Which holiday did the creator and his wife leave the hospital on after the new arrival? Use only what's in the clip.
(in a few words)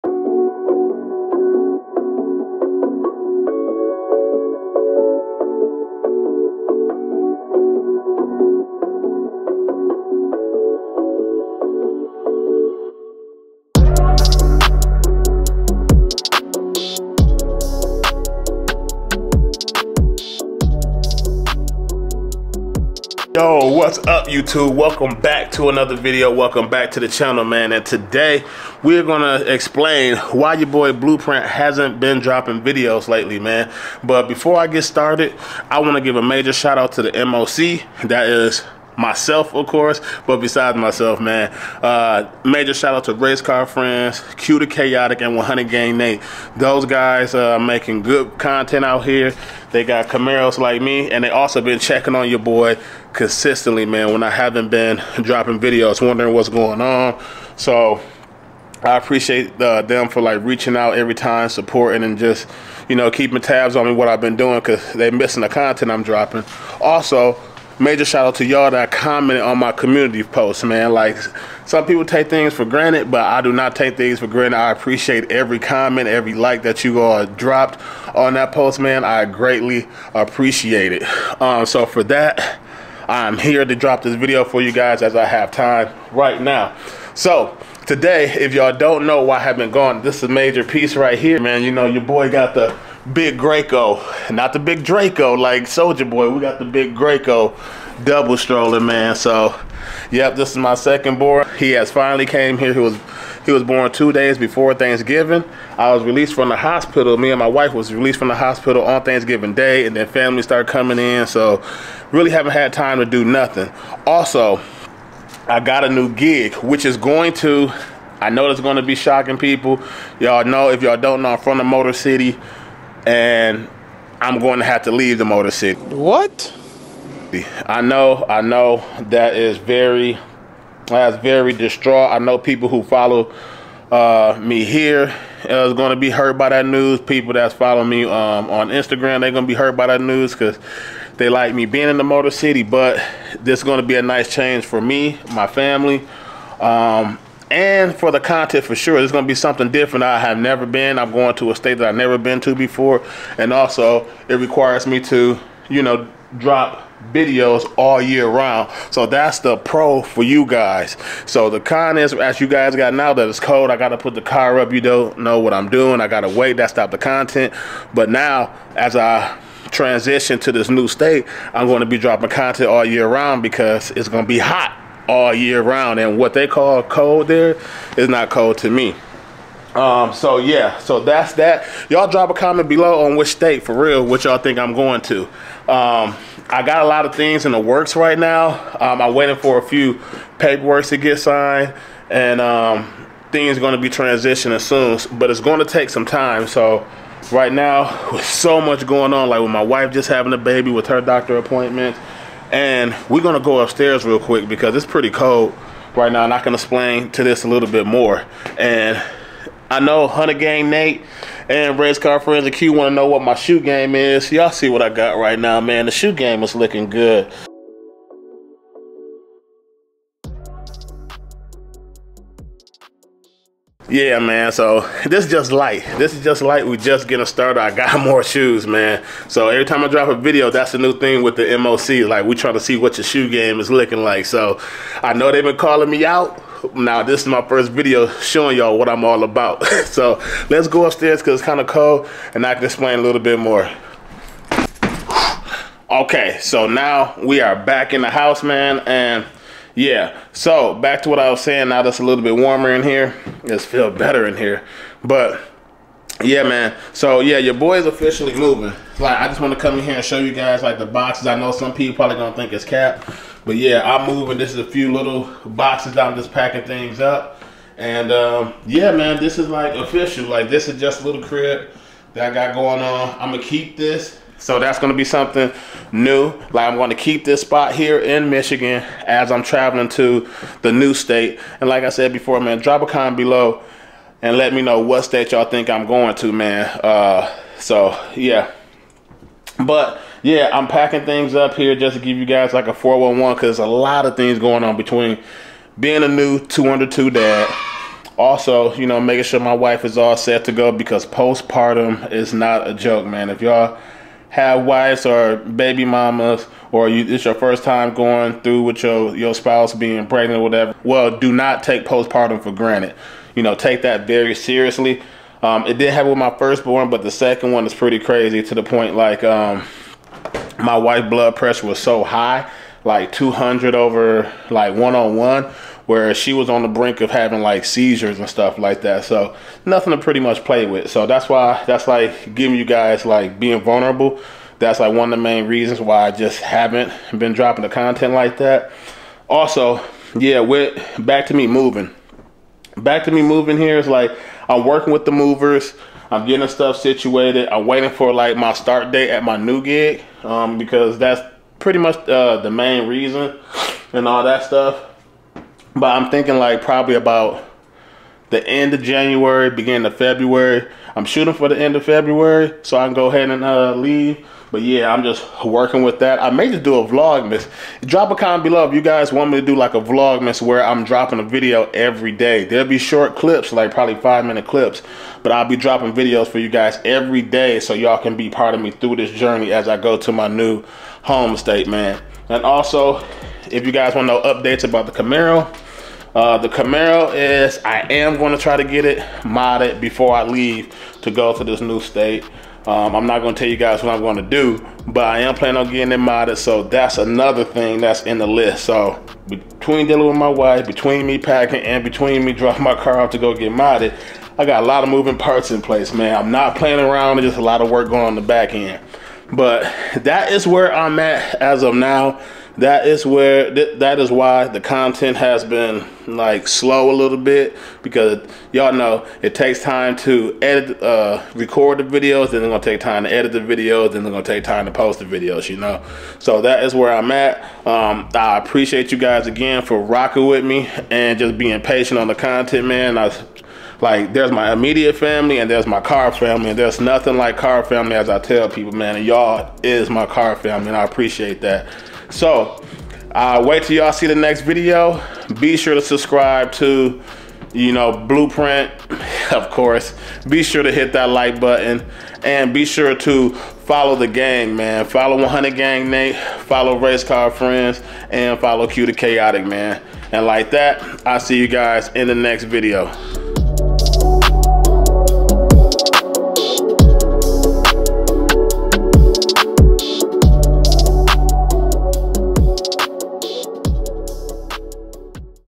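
Thanksgiving Day.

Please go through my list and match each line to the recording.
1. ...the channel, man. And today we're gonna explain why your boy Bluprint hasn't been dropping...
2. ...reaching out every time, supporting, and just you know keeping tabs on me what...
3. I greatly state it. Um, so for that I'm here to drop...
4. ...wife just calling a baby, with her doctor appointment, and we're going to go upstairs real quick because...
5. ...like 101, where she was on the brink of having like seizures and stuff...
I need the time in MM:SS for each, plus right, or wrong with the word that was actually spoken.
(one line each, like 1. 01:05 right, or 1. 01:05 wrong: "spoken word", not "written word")
1. 00:26 right
2. 01:00 right
3. 01:19 wrong: "appreciate", not "state"
4. 03:19 wrong: "having", not "calling"
5. 05:24 right.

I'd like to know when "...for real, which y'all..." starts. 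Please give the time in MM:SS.
03:03.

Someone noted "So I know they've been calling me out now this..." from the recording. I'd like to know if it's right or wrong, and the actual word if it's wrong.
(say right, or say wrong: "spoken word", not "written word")
right.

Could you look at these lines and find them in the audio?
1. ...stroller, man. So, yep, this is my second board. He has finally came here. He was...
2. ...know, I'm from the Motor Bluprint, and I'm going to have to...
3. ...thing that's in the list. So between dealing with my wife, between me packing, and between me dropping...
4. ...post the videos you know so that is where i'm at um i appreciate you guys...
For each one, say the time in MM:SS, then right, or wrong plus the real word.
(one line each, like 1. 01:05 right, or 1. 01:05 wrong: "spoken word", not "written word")
1. 01:38 right
2. 02:01 wrong: "City", not "Bluprint"
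3. 06:37 right
4. 07:04 right.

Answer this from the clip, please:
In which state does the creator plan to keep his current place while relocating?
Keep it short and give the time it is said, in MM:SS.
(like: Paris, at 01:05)
Michigan, at 04:38.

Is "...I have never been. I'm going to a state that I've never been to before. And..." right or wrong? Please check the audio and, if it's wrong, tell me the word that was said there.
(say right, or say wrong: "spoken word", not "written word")
right.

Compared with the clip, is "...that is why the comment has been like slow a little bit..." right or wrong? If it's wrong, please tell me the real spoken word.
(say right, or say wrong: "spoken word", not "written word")
wrong: "content", not "comment".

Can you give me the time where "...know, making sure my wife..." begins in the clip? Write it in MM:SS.
04:58.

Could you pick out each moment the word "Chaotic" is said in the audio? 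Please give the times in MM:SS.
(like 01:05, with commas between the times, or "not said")
00:44, 07:38.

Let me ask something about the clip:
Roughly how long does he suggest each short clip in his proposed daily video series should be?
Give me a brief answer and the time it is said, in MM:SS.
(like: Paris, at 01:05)
5 minutes, at 06:13.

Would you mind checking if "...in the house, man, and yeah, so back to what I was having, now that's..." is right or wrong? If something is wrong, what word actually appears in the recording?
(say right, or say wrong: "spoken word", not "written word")
wrong: "saying", not "having".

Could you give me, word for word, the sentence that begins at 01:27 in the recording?
So today, if y'all don't know why I have been gone, this is a major piece right here, man.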